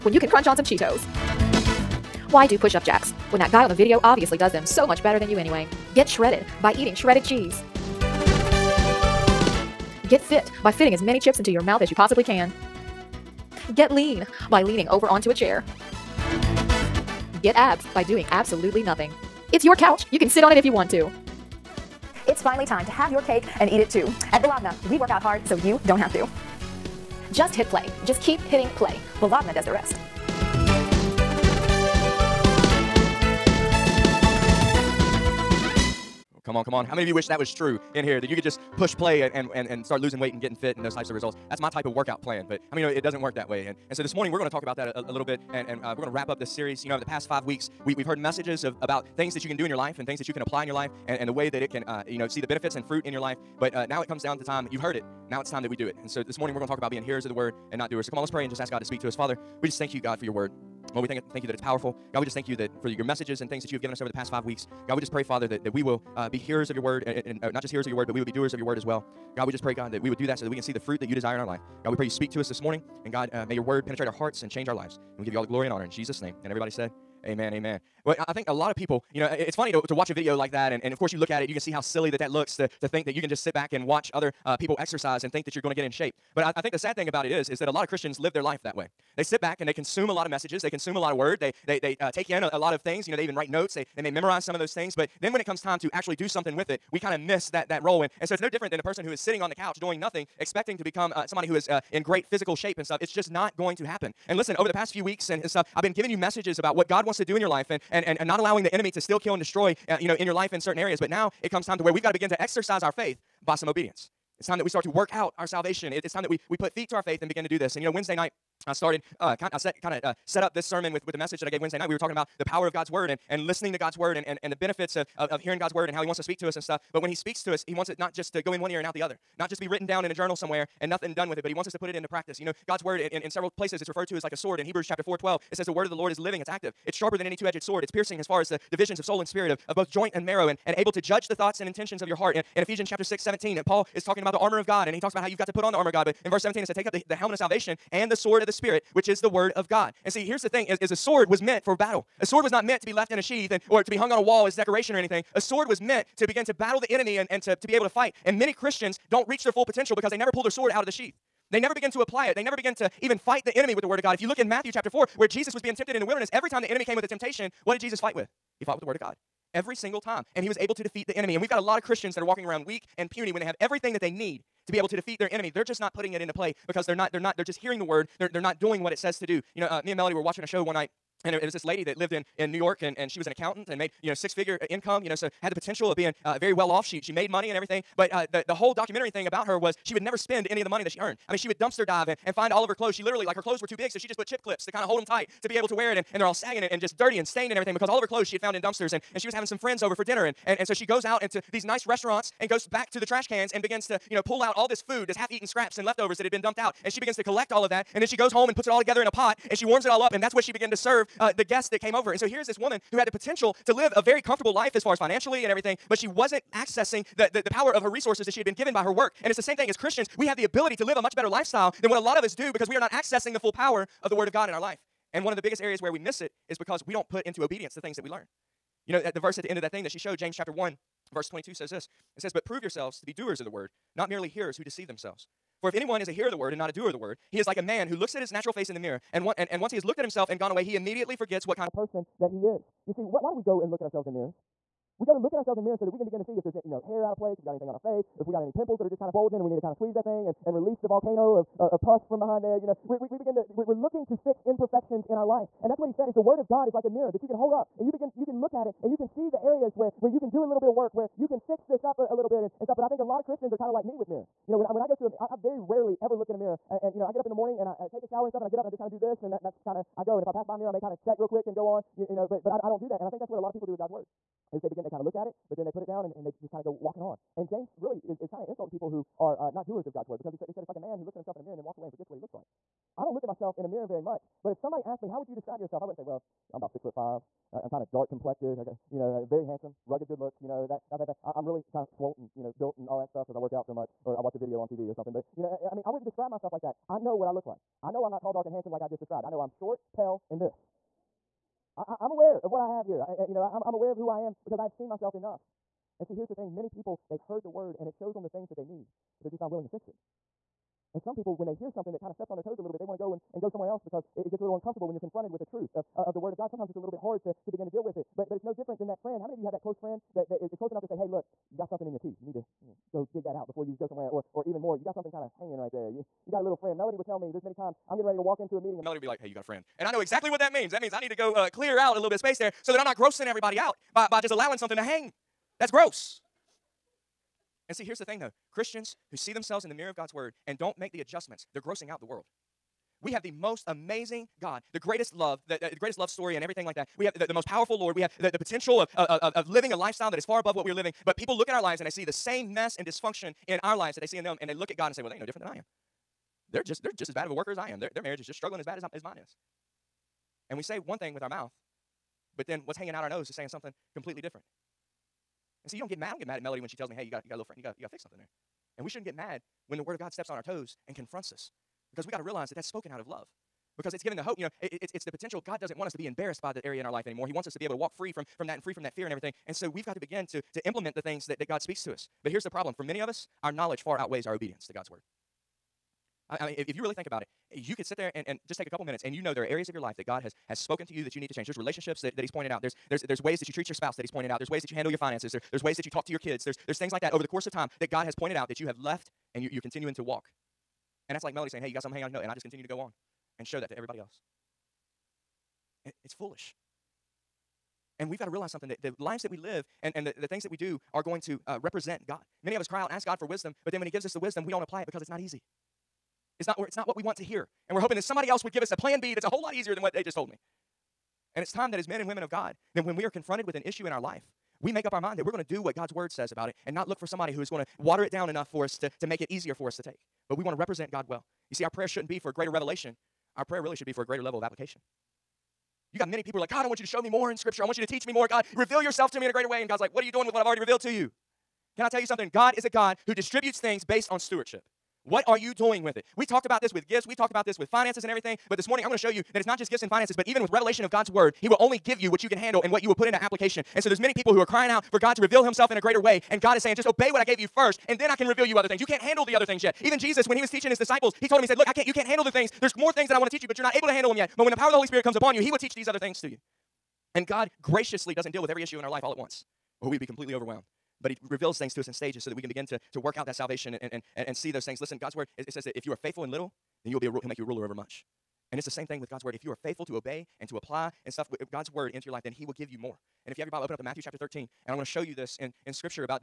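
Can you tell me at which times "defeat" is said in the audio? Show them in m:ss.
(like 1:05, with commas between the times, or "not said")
2:50, 2:54.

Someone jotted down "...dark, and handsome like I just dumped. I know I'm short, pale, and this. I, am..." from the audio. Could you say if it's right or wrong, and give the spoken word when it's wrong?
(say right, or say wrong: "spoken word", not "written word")
wrong: "described", not "dumped".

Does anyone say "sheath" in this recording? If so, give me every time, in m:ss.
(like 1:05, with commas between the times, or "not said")
2:33, 2:40.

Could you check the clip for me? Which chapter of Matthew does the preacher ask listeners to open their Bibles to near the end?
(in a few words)
Matthew 13.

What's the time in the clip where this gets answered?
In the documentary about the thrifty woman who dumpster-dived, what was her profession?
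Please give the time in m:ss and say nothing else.
3:03.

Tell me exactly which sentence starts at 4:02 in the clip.
You see, what, why do we go and look at ourselves in mirrors?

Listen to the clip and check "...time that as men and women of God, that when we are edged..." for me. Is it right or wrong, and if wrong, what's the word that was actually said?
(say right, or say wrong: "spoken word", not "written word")
wrong: "confronted", not "edged".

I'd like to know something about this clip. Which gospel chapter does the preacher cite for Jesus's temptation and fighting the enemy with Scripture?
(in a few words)
Matthew 4.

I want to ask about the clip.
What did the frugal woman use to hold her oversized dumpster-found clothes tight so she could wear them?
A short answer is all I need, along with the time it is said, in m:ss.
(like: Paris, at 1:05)
Chip clips, at 3:14.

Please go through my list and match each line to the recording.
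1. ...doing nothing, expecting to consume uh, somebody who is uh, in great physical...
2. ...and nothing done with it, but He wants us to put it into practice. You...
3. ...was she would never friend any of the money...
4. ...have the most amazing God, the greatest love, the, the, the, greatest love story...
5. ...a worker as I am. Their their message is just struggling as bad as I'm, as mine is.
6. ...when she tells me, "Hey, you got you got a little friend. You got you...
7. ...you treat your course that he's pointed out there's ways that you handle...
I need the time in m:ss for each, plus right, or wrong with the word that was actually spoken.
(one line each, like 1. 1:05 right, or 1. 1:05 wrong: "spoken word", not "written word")
1. 1:39 wrong: "become", not "consume"
2. 2:10 right
3. 3:09 wrong: "spend", not "friend"
4. 5:43 right
5. 5:57 wrong: "marriage", not "message"
6. 6:06 right
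7. 6:33 wrong: "spouse", not "course".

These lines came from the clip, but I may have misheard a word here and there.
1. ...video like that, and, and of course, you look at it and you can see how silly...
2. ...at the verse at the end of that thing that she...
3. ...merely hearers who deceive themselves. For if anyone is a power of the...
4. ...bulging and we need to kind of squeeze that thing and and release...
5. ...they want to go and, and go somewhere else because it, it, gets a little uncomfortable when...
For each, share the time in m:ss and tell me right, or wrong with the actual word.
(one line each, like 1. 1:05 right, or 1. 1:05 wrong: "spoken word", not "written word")
1. 1:20 right
2. 3:48 right
3. 3:54 wrong: "hearer", not "power"
4. 4:09 right
5. 5:12 right.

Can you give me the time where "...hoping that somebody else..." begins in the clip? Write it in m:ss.
6:57.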